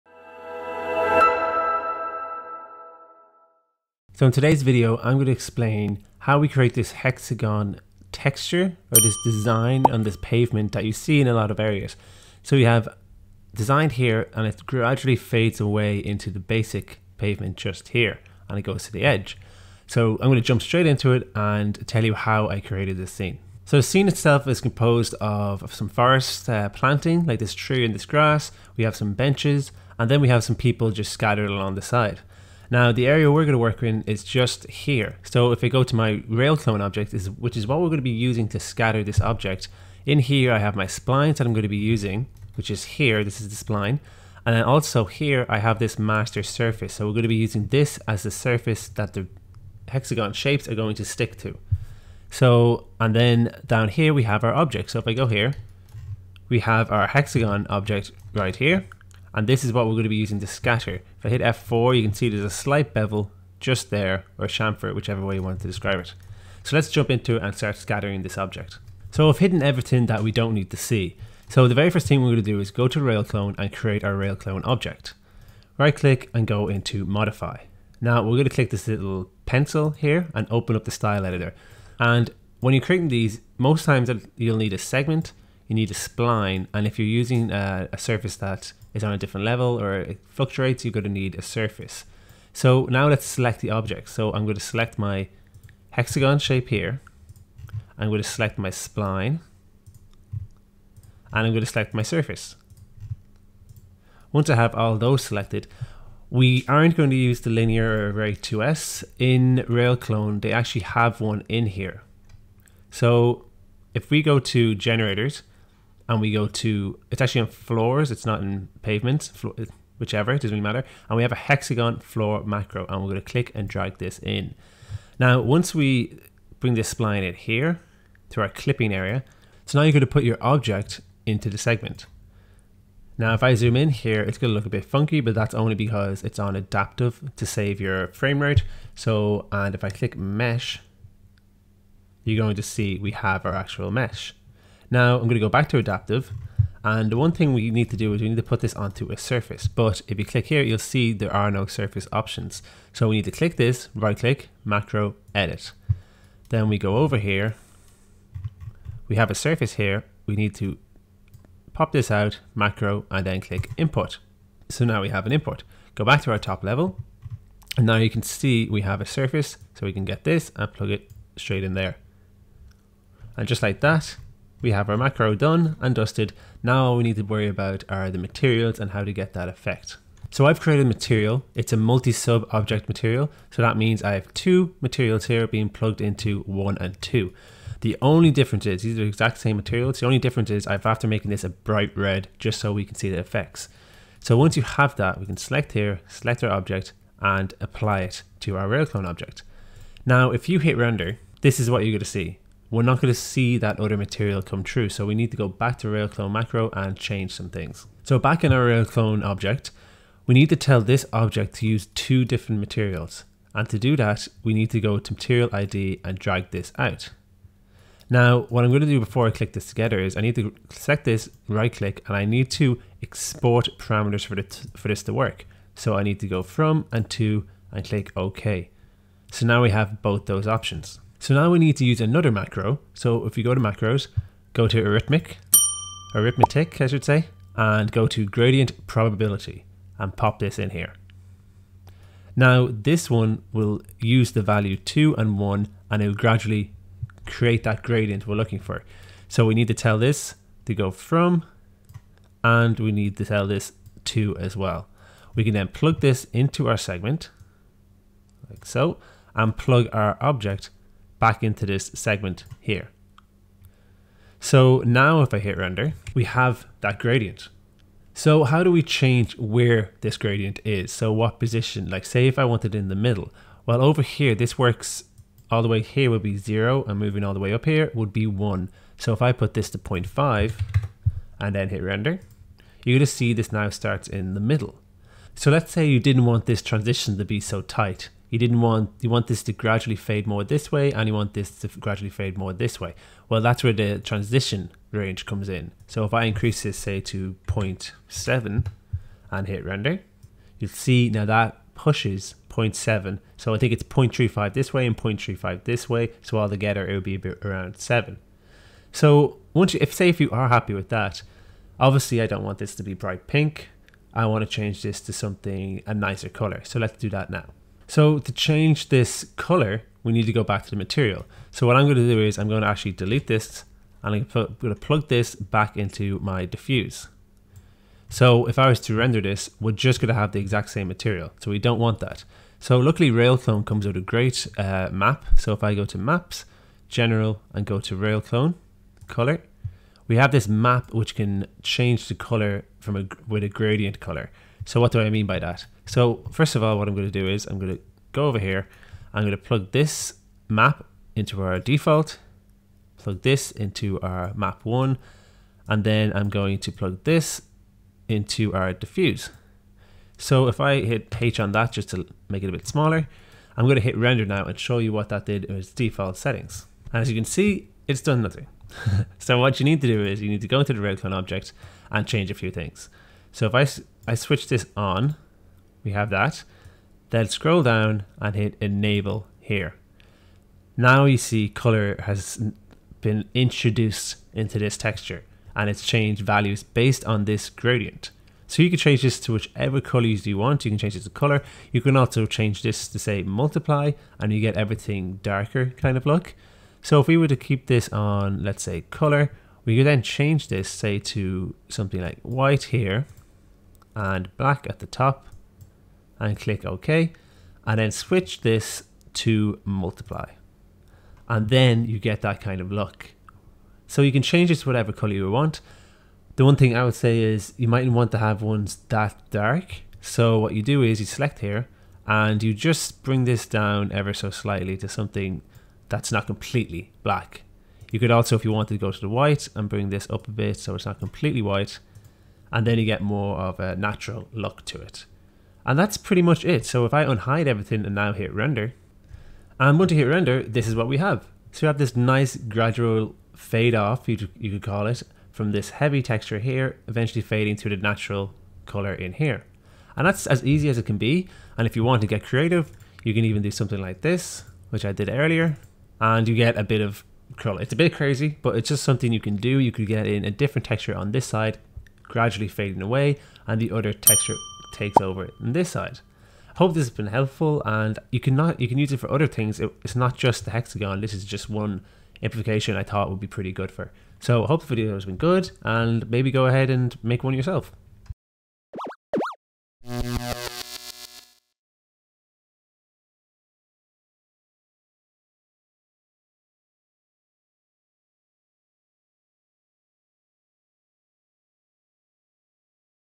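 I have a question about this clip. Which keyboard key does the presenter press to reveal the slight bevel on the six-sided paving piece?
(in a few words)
F4.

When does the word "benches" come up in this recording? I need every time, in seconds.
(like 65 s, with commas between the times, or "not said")
29 s.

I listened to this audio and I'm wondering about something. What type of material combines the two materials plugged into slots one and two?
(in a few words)
multi-sub object material.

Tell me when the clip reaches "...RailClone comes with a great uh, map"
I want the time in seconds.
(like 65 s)
333 s.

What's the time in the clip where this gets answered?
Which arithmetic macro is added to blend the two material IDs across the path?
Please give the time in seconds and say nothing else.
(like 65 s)
238 s.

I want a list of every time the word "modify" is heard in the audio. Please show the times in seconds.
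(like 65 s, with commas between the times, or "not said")
77 s.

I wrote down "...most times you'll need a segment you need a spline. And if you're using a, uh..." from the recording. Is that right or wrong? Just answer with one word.
right.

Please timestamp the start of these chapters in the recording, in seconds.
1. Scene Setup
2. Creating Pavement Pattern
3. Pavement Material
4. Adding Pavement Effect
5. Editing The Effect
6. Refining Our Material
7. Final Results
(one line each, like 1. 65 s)
1. 23 s
2. 70 s
3. 180 s
4. 207 s
5. 271 s
6. 318 s
7. 443 s.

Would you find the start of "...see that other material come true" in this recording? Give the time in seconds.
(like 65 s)
203 s.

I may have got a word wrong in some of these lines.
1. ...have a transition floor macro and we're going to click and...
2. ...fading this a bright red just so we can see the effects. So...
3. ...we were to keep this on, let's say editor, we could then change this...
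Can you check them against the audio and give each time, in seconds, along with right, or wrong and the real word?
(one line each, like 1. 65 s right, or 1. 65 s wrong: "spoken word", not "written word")
1. 121 s wrong: "hexagon", not "transition"
2. 191 s wrong: "making", not "fading"
3. 397 s wrong: "color", not "editor".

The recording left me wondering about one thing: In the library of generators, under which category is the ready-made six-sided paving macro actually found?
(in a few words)
floors.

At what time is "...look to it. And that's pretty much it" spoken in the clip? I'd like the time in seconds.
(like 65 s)
434 s.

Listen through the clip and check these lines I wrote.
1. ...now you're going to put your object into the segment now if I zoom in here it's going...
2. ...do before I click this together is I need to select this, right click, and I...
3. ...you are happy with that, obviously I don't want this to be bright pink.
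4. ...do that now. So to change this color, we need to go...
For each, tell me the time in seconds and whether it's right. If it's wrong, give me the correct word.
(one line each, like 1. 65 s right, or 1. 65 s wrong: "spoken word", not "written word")
1. 129 s right
2. 218 s right
3. 310 s right
4. 316 s right.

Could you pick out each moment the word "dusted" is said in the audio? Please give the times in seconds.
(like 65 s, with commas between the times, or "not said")
175 s.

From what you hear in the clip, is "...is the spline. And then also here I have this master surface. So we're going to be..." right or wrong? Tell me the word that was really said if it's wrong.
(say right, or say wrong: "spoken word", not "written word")
right.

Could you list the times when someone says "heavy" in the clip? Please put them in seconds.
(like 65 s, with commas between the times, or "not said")
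445 s.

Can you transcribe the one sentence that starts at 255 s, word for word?
We can then plug this into our segment like so and plug our object back into this segment here.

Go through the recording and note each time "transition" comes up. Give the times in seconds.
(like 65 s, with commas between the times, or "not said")
286 s, 293 s.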